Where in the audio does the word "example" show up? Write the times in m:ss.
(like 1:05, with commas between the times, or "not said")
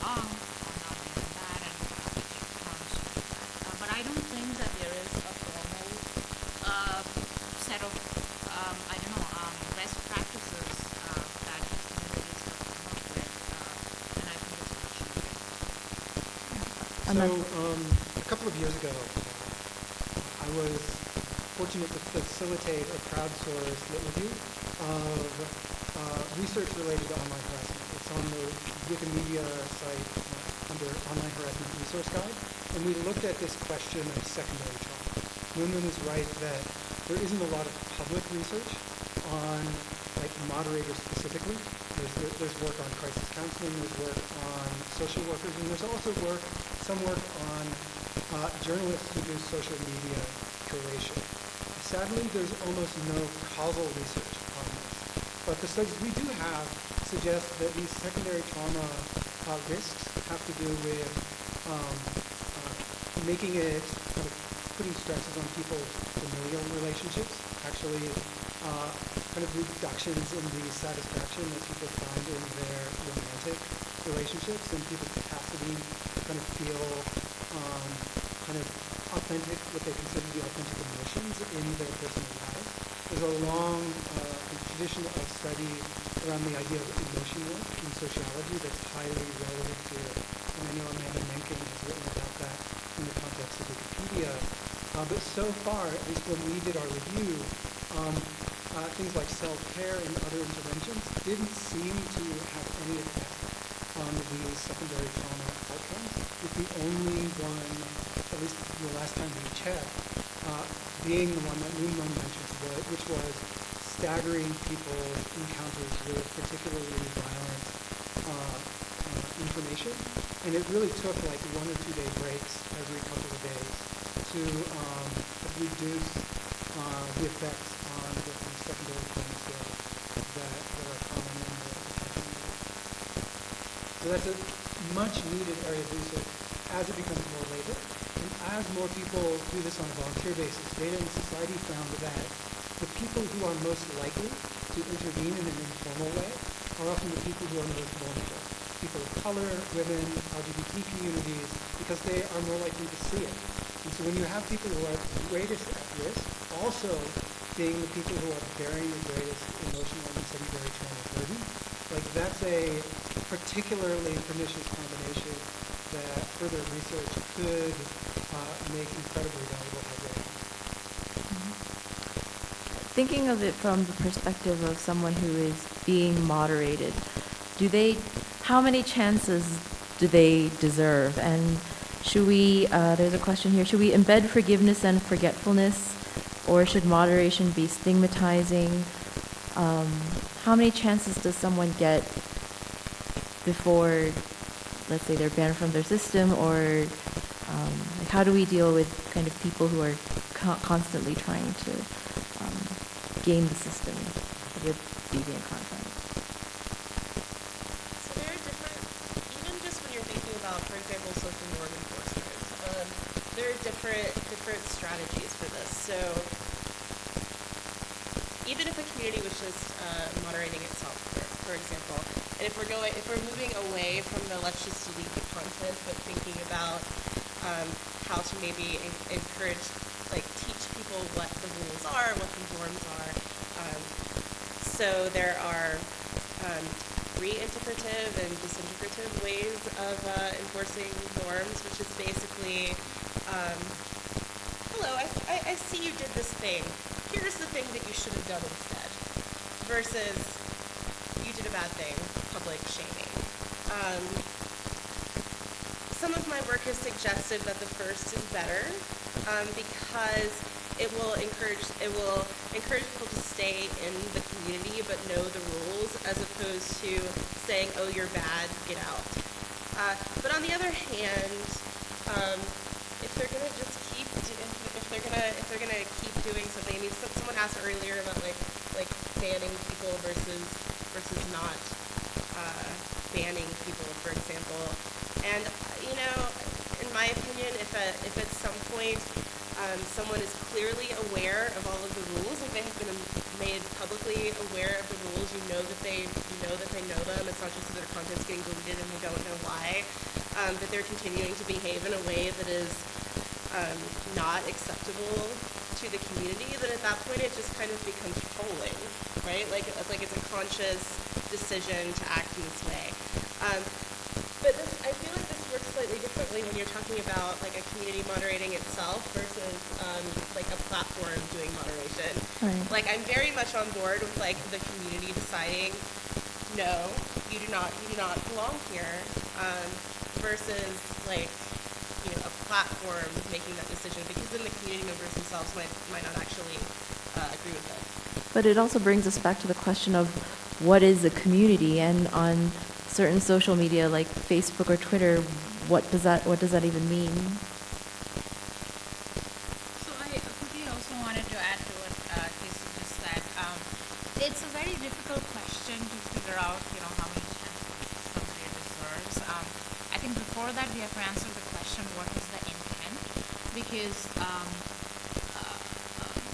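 3:30, 3:41, 4:44.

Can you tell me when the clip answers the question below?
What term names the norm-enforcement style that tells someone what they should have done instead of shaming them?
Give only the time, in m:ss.
3:57.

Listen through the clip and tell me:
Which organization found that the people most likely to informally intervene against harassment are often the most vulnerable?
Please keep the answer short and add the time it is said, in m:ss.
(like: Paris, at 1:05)
Data and Society, at 2:20.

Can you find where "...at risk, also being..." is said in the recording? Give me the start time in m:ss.
2:35.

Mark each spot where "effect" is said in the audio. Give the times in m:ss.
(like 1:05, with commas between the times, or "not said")
1:42, 2:07.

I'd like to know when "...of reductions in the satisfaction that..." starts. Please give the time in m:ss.
1:09.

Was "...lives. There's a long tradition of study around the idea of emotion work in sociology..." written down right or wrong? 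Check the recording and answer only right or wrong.
right.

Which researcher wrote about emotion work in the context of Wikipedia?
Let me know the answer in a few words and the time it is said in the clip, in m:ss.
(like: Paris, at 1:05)
Amanda Menking, at 1:30.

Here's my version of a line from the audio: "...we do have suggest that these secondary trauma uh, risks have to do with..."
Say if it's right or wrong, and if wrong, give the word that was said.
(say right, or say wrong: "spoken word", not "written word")
right.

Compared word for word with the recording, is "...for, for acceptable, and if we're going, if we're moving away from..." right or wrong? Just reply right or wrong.
wrong.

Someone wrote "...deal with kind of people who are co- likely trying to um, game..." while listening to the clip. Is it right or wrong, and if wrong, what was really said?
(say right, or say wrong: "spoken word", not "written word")
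wrong: "constantly", not "likely".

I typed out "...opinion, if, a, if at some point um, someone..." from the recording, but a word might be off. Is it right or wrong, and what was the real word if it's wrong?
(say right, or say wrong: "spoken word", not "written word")
right.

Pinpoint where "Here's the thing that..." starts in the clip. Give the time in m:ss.
4:07.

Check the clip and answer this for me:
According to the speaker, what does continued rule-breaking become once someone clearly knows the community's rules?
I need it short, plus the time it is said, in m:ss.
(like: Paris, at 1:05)
Trolling, at 5:08.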